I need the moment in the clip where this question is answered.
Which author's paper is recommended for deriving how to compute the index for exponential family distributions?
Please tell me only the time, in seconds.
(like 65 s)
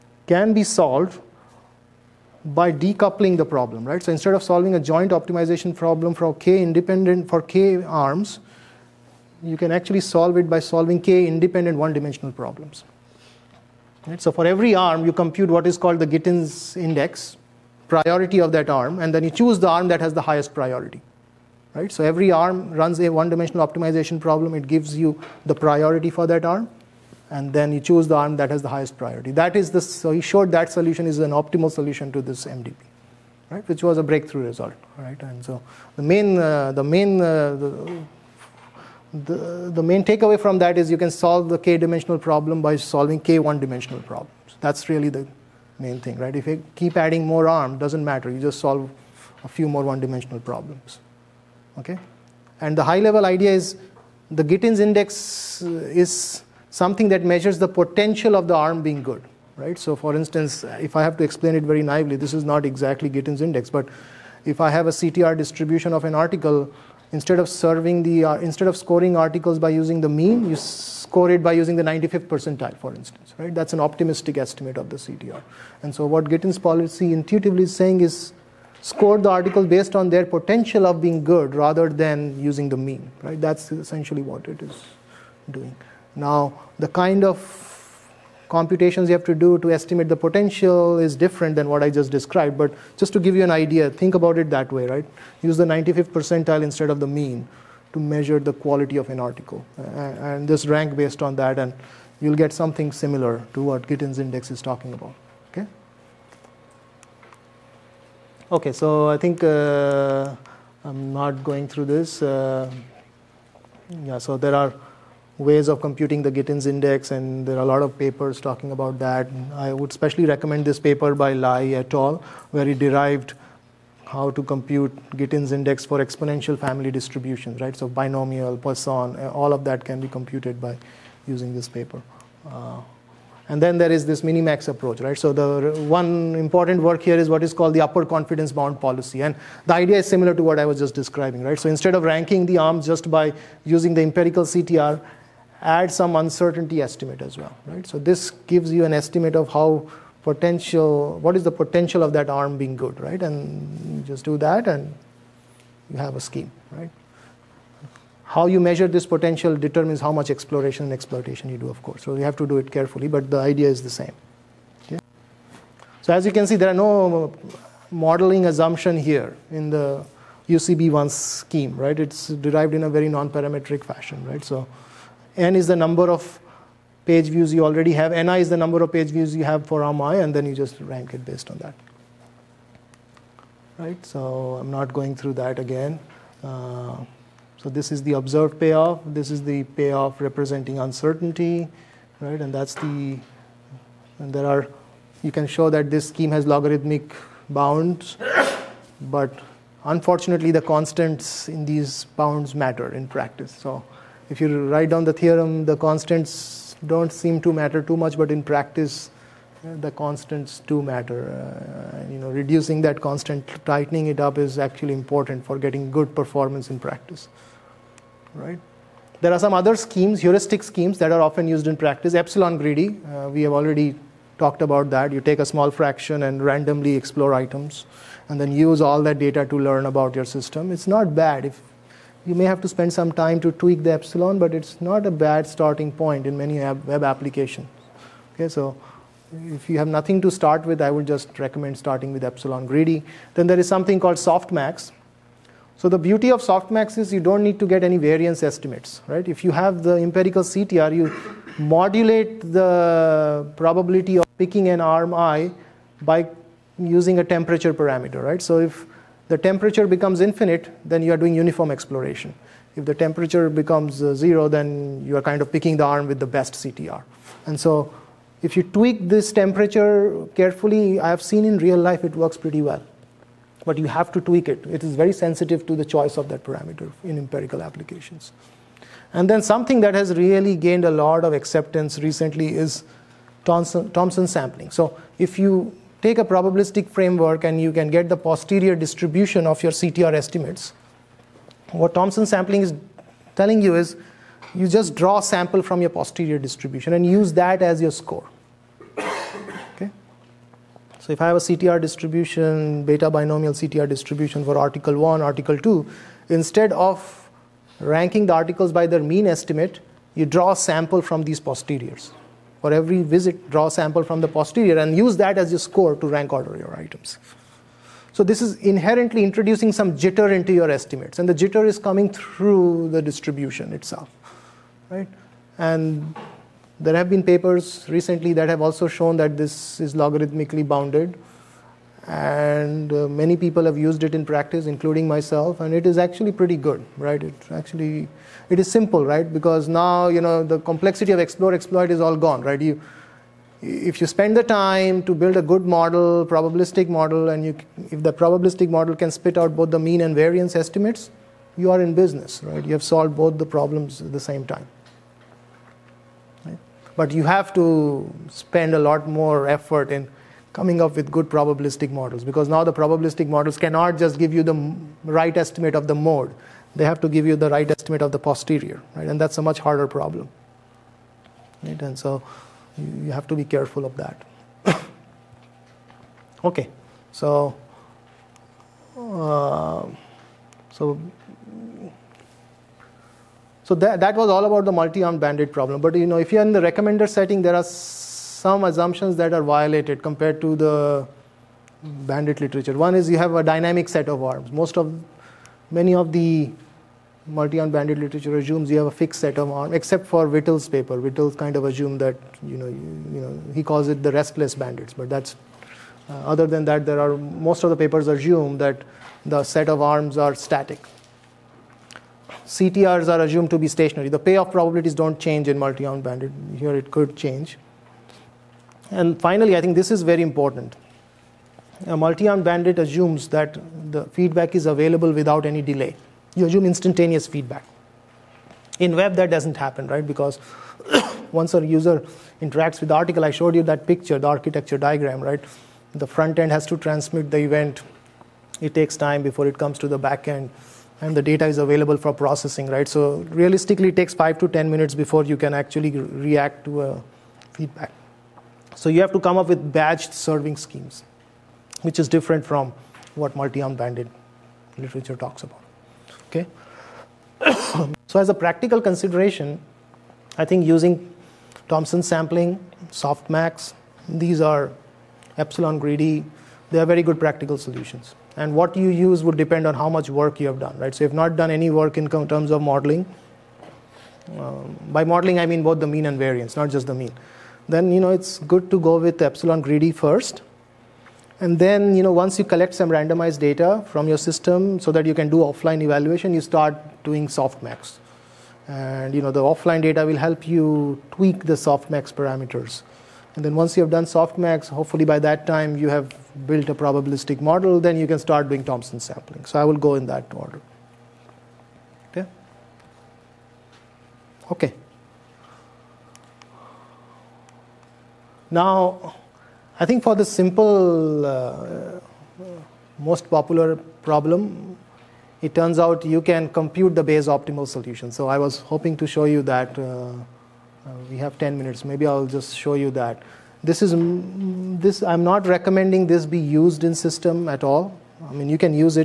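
121 s.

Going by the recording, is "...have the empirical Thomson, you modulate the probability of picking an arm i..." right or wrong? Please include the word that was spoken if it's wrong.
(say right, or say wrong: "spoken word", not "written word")
wrong: "CTR", not "Thomson".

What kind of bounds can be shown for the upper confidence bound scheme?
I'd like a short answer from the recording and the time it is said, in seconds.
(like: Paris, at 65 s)
logarithmic bounds, at 196 s.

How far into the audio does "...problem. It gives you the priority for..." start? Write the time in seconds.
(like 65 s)
24 s.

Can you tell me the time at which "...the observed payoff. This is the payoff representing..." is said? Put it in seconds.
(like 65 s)
188 s.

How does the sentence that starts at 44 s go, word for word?
That's really the main thing, right?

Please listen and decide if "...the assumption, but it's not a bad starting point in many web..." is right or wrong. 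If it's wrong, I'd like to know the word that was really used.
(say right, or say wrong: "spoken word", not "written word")
wrong: "epsilon", not "assumption".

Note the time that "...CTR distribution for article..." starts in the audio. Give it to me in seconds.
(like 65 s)
303 s.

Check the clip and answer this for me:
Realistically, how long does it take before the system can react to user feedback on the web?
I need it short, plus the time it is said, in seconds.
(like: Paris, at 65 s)
5 to 10 minutes, at 444 s.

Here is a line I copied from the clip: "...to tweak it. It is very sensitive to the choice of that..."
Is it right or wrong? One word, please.
right.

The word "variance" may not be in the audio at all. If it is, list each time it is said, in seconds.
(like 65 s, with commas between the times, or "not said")
247 s, 350 s, 476 s.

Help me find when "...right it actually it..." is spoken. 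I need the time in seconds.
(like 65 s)
336 s.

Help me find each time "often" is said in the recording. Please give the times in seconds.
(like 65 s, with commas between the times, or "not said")
221 s.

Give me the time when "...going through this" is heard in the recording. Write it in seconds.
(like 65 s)
111 s.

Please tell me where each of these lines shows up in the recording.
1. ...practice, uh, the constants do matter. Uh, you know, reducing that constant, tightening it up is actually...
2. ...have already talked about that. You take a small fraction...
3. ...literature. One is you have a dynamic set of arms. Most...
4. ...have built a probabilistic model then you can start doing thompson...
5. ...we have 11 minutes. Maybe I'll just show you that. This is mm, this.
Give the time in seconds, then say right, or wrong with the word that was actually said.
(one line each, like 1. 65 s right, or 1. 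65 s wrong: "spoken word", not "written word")
1. 208 s right
2. 223 s right
3. 392 s right
4. 495 s right
5. 521 s wrong: "10", not "11".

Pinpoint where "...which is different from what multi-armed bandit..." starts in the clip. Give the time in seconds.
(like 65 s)
451 s.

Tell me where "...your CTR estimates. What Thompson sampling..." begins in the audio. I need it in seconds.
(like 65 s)
289 s.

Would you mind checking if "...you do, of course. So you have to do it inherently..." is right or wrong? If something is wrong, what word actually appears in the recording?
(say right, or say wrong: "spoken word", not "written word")
wrong: "carefully", not "inherently".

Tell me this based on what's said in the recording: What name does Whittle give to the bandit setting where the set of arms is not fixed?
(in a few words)
restless bandits.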